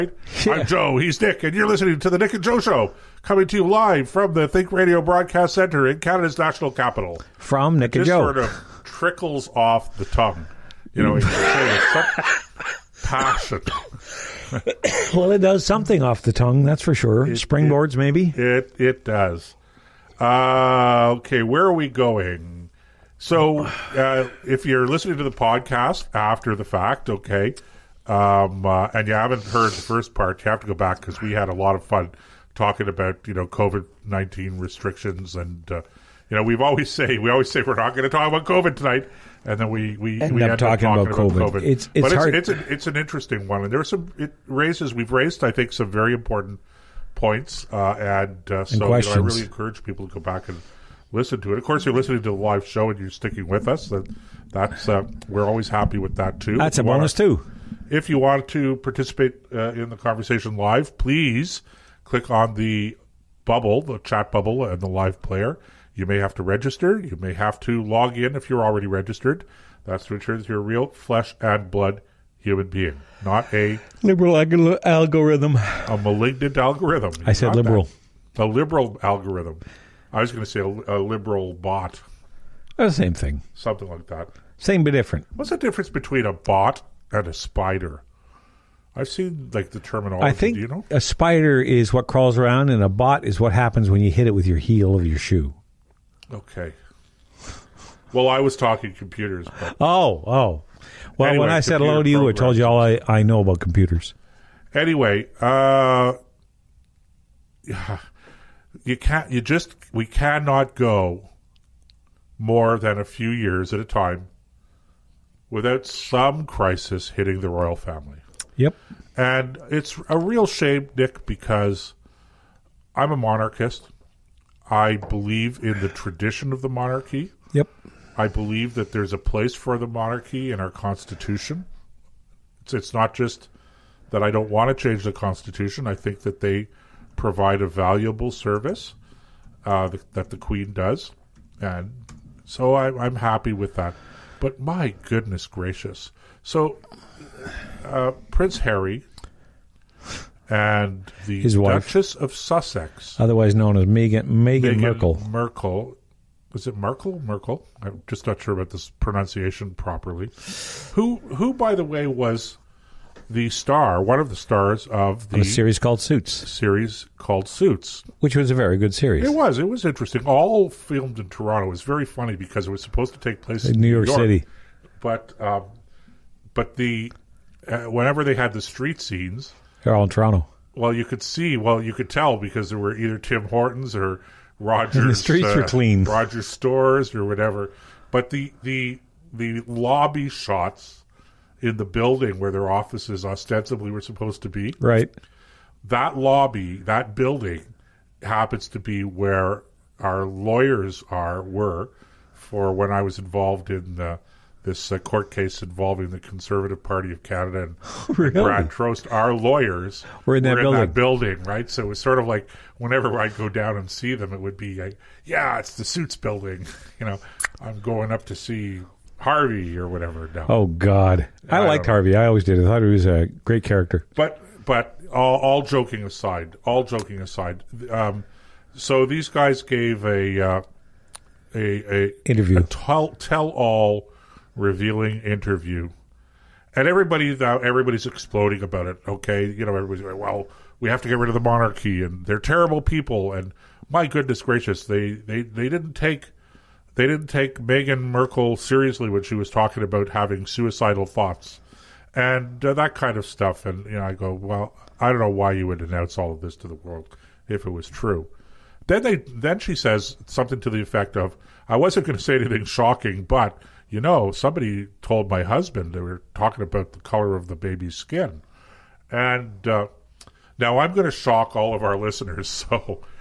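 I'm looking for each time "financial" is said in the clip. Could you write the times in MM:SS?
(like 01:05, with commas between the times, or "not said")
not said.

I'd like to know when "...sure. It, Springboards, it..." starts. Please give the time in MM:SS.
00:16.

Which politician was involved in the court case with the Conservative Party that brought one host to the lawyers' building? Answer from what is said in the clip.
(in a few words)
Brad Trost.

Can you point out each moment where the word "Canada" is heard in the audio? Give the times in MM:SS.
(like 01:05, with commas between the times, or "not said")
00:05, 03:27.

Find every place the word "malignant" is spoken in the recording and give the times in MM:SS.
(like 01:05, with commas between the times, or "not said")
01:16.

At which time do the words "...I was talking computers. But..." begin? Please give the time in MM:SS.
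01:38.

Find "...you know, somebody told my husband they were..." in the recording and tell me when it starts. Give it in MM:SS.
04:23.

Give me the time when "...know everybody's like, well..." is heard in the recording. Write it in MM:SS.
03:59.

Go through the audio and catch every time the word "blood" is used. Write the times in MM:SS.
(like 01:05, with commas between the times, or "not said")
01:11.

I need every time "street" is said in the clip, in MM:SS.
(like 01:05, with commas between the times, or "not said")
02:58, 03:05.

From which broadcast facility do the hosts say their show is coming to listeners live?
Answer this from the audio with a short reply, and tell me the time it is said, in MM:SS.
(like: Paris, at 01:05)
Think Radio Broadcast Centre, at 00:04.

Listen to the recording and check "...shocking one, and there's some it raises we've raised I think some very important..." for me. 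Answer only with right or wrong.
wrong.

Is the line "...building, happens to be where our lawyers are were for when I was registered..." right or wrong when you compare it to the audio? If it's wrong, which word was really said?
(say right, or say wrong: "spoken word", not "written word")
wrong: "involved", not "registered".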